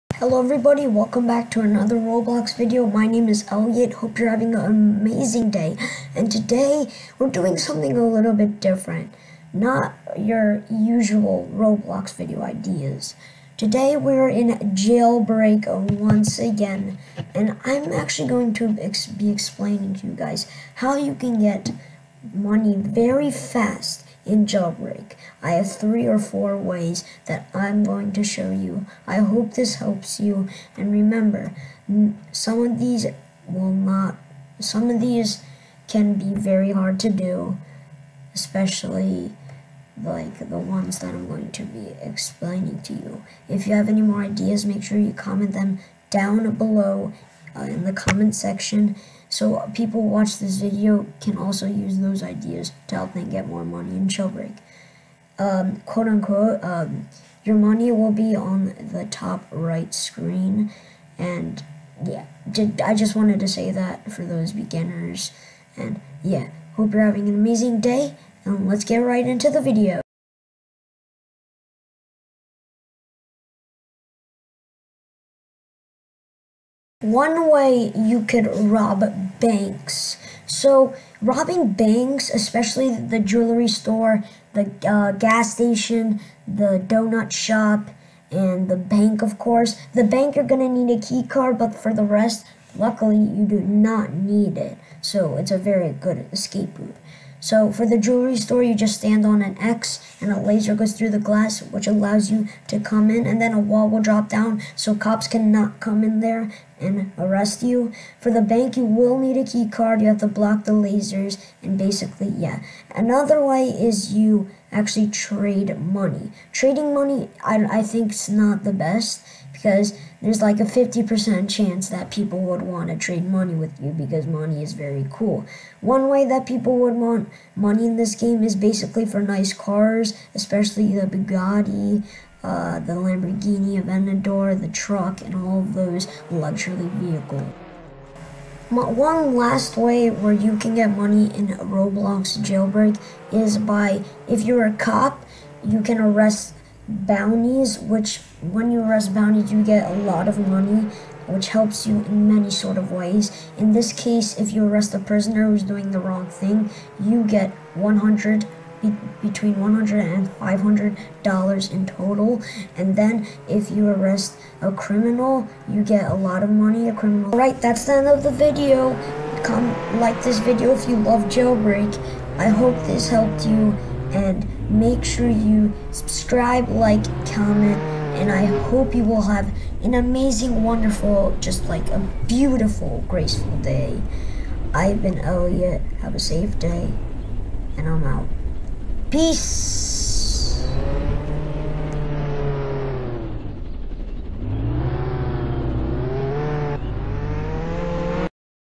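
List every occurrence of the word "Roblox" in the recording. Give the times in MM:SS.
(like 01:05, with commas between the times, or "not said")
00:01, 00:11, 02:21.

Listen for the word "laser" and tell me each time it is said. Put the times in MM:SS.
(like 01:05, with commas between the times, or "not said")
01:40, 01:50.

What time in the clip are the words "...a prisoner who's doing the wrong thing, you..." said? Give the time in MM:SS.
02:34.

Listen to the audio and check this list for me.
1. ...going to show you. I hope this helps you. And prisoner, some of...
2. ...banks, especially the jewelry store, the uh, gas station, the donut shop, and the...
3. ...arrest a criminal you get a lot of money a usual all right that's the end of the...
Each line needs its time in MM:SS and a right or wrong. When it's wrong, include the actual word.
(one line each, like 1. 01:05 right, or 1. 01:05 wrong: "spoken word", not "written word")
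1. 00:27 wrong: "remember", not "prisoner"
2. 01:21 right
3. 02:43 wrong: "criminal", not "usual".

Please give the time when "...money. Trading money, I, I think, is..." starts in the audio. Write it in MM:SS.
01:55.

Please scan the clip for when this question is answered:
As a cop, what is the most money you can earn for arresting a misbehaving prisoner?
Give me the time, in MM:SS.
02:40.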